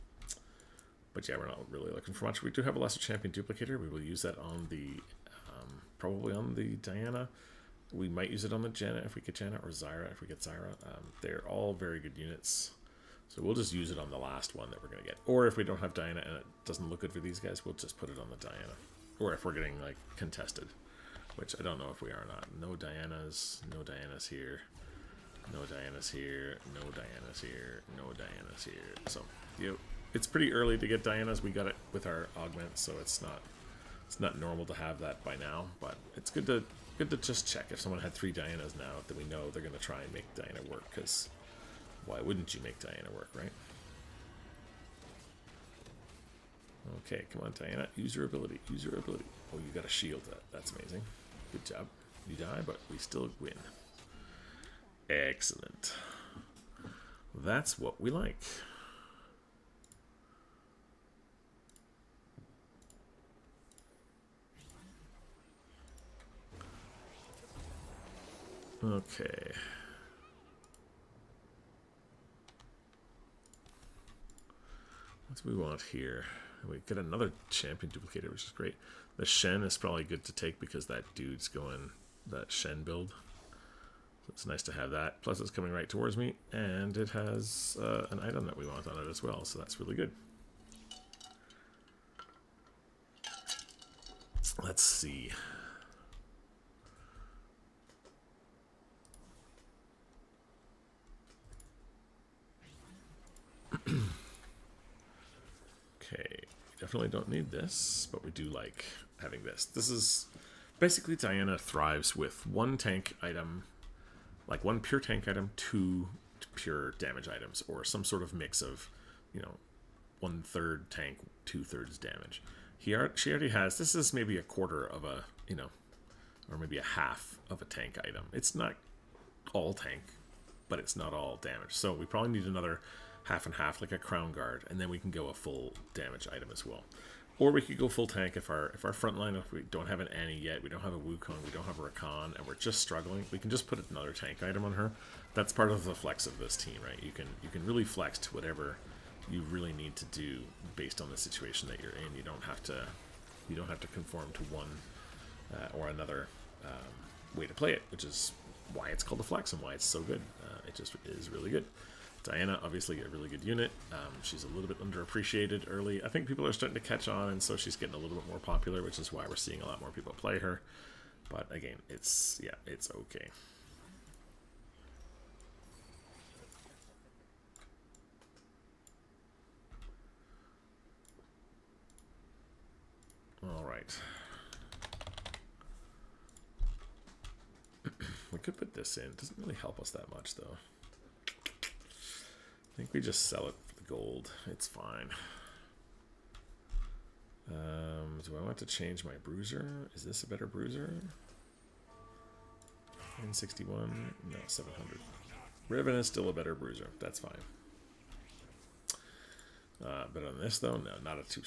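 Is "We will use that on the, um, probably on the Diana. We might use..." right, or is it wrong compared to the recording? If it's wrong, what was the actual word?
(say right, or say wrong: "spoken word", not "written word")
right.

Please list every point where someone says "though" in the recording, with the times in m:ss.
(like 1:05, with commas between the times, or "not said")
3:10, 3:30.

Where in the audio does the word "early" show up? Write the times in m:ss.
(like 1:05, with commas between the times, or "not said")
0:30, 2:45.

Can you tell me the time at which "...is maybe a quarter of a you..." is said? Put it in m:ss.
2:03.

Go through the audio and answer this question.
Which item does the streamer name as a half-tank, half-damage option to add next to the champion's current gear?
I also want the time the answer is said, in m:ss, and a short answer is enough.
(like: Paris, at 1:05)
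Crown guard, at 2:13.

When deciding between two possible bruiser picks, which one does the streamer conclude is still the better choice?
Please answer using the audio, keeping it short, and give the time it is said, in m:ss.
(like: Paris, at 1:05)
Ribbon, at 3:25.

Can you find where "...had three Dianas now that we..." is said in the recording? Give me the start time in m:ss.
0:37.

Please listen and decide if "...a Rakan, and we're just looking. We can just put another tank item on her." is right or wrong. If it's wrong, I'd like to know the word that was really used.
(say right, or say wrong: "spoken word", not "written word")
wrong: "struggling", not "looking".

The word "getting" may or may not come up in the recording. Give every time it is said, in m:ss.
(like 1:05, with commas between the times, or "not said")
0:19, 2:47.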